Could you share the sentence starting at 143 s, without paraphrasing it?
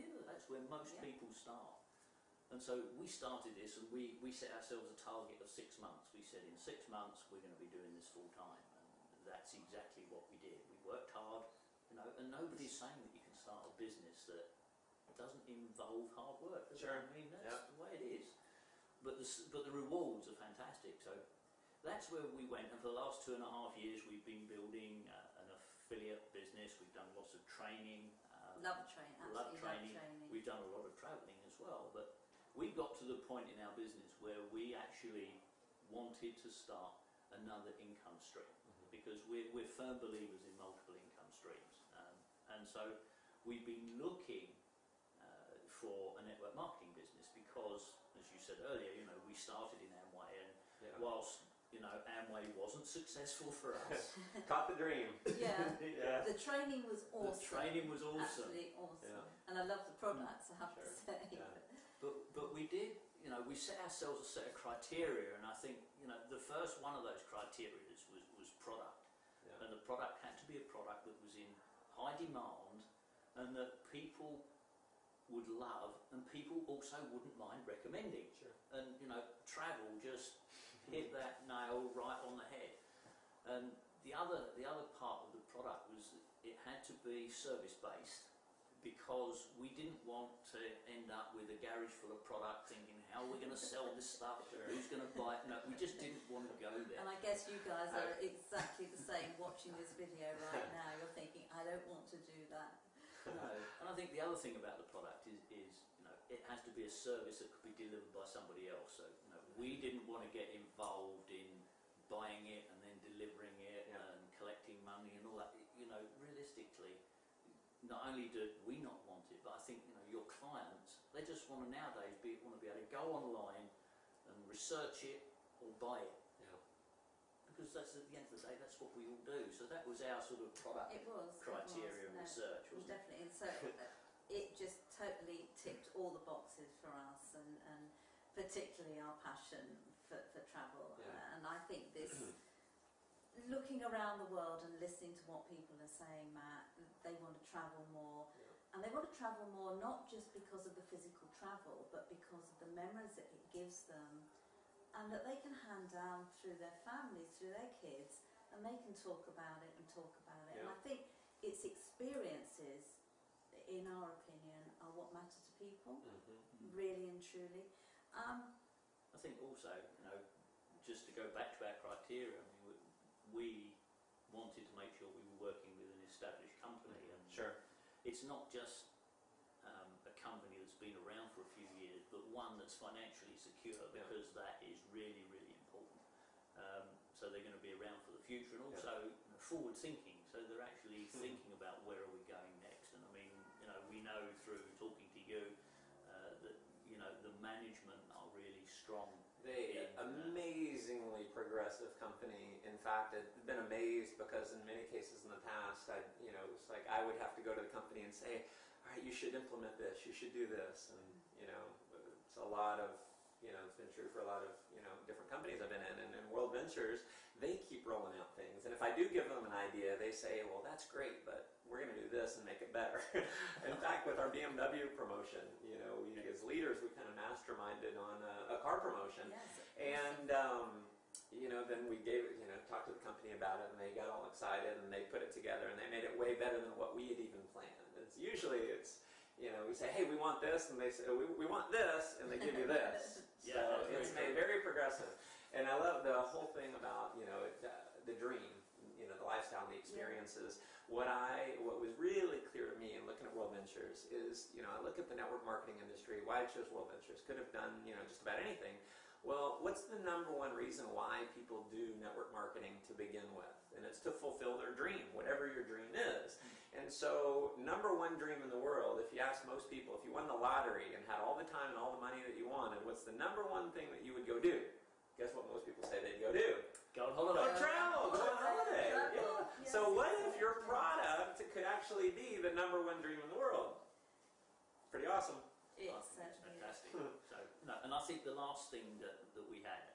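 looking around the world and listening to what people are saying, Matt, they want to travel more.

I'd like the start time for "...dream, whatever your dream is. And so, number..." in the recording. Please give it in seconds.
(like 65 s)
264 s.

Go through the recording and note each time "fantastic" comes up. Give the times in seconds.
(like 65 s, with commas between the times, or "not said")
20 s, 286 s.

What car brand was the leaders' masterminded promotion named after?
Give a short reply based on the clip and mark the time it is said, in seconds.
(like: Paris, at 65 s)
BMW, at 224 s.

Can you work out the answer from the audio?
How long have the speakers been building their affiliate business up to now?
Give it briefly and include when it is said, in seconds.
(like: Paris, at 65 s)
2 and a half years, at 23 s.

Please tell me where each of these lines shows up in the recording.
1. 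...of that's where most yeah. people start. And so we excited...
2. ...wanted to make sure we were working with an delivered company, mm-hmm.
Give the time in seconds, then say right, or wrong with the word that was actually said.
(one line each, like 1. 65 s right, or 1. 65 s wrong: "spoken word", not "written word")
1. 0 s wrong: "started", not "excited"
2. 174 s wrong: "established", not "delivered".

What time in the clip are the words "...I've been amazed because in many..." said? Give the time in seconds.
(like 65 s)
203 s.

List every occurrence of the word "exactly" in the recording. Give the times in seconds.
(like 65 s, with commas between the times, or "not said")
9 s, 98 s.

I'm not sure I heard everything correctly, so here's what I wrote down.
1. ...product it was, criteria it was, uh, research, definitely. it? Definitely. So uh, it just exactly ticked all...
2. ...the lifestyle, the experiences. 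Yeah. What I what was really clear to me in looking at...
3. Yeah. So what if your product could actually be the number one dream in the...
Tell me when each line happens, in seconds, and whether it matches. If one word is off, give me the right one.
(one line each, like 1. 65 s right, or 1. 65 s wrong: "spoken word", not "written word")
1. 130 s wrong: "totally", not "exactly"
2. 249 s right
3. 278 s right.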